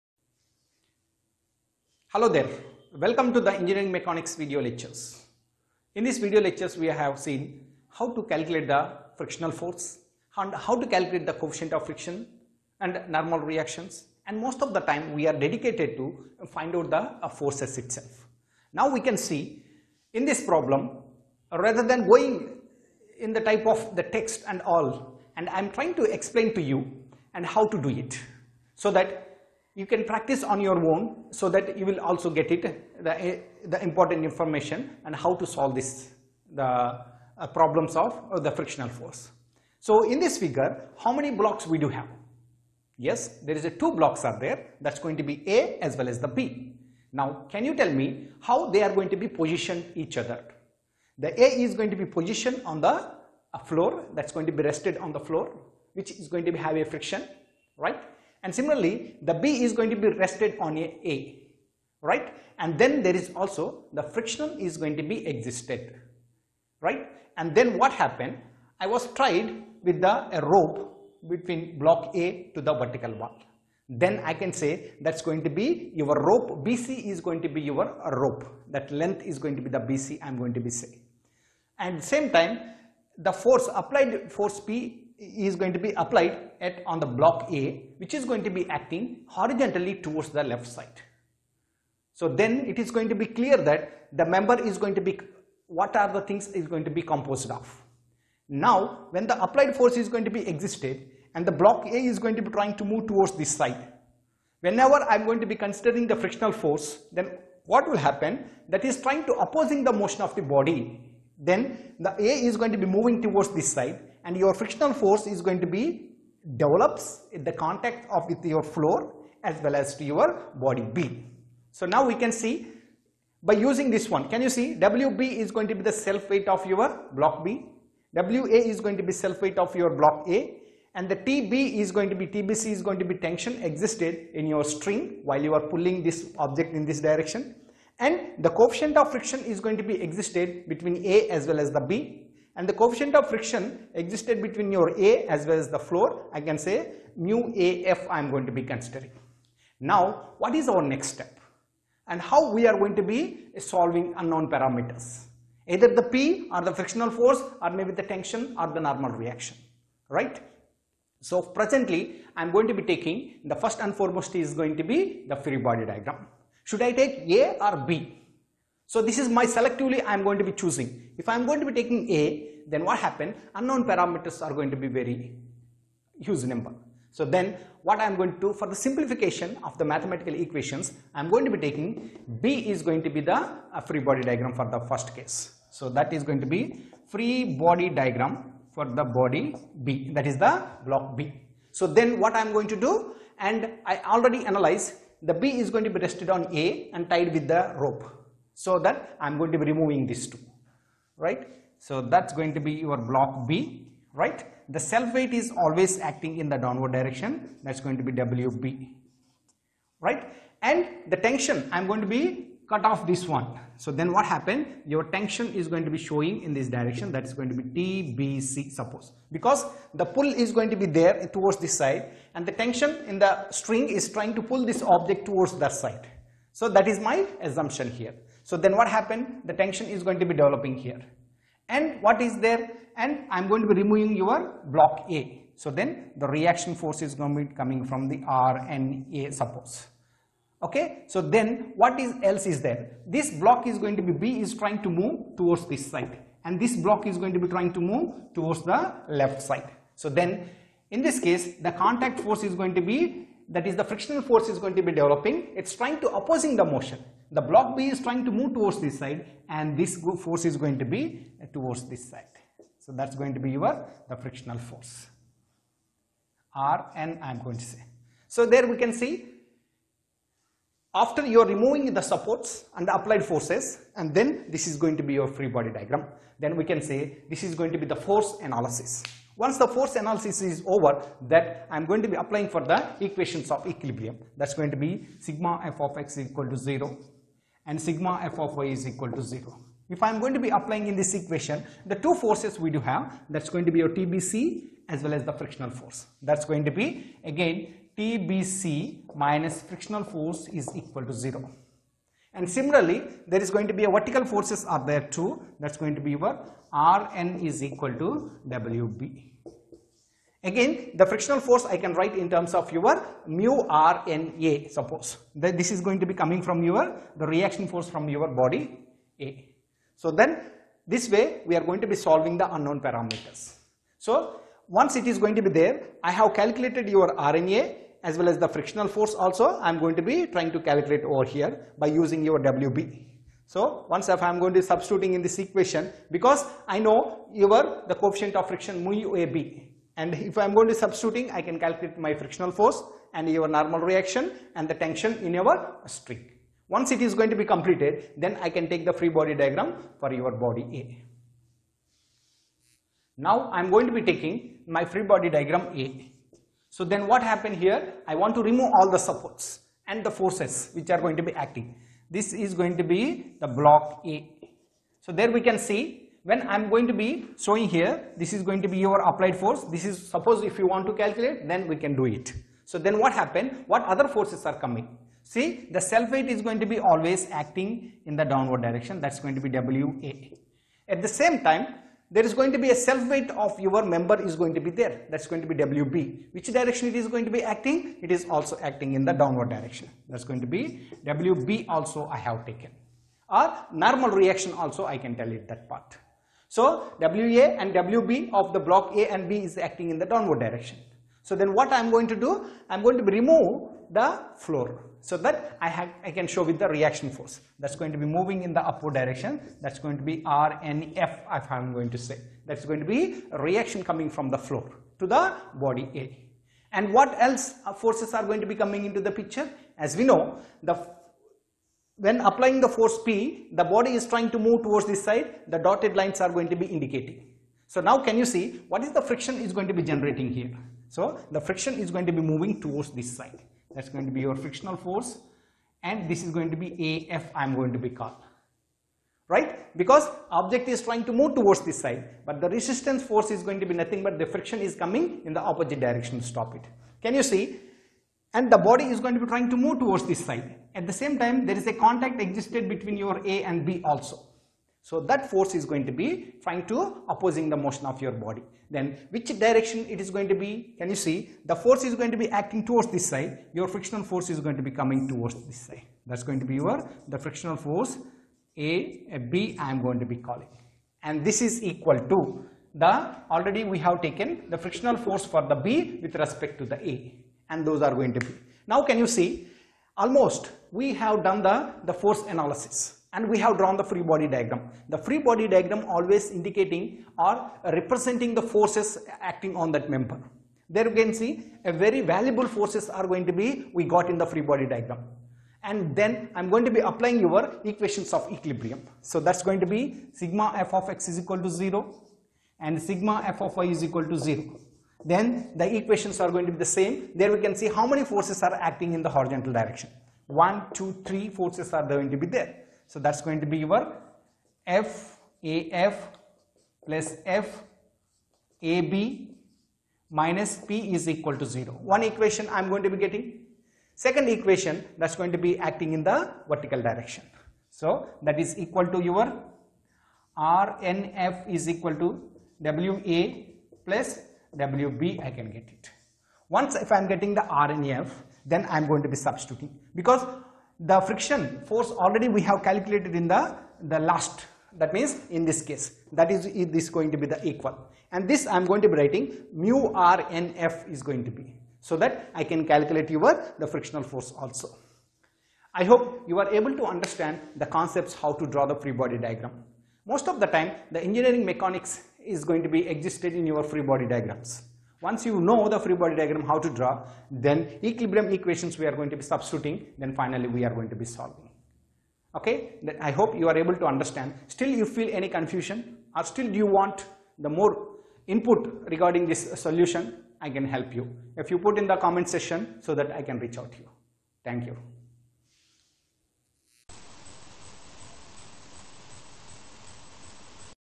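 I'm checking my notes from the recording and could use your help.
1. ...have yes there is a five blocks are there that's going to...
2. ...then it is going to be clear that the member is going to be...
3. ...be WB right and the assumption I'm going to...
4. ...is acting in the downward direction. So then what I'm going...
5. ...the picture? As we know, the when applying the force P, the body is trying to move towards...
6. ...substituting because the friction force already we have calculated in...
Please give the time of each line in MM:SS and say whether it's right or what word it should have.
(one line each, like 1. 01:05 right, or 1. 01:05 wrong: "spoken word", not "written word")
1. 00:41 wrong: "two", not "five"
2. 01:32 right
3. 03:28 wrong: "tension", not "assumption"
4. 06:39 right
5. 06:58 right
6. 08:59 right.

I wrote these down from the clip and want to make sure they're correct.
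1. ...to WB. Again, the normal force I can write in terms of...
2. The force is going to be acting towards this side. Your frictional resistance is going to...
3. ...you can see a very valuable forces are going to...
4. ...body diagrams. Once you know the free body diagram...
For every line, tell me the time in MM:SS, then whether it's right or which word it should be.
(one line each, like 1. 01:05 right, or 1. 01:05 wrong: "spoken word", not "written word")
1. 05:07 wrong: "frictional", not "normal"
2. 07:41 wrong: "force", not "resistance"
3. 08:10 right
4. 09:23 right.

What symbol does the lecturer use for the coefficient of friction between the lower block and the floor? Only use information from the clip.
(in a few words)
mu AF.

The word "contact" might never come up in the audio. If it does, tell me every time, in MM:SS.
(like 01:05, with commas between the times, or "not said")
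01:57, 04:11, 07:31.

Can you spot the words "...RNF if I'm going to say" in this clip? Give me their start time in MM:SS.
06:50.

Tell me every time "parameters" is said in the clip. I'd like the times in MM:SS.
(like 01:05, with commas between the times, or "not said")
02:34, 02:53, 05:22.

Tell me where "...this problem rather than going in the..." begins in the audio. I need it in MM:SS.
00:20.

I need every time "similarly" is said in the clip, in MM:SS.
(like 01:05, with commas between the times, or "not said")
00:58, 05:02.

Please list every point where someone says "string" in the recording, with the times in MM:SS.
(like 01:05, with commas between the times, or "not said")
02:14, 03:43, 05:45.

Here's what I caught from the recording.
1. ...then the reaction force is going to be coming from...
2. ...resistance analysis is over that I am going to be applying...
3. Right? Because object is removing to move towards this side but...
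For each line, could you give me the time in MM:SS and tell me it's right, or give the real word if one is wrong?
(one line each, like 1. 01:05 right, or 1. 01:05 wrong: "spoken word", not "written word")
1. 03:55 right
2. 04:39 wrong: "force", not "resistance"
3. 07:19 wrong: "trying", not "removing".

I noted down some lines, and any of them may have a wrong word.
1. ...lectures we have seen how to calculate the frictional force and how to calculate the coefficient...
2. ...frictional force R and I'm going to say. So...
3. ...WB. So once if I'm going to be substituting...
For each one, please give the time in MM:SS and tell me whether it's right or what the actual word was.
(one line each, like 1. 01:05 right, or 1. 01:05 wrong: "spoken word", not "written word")
1. 00:06 right
2. 04:24 right
3. 05:32 right.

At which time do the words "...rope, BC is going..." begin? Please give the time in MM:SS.
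01:16.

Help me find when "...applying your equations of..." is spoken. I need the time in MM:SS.
08:16.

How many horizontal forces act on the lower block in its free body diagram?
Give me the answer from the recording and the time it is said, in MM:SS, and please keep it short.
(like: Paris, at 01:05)
3, at 08:31.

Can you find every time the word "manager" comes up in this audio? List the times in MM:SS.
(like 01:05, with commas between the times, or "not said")
not said.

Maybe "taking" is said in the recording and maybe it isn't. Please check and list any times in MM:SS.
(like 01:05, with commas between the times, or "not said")
02:42, 02:51, 03:01, 05:54.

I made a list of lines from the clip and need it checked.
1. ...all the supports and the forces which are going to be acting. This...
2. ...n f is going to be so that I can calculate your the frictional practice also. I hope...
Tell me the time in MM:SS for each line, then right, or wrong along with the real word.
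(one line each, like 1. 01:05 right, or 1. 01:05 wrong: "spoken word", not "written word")
1. 05:58 right
2. 09:10 wrong: "force", not "practice".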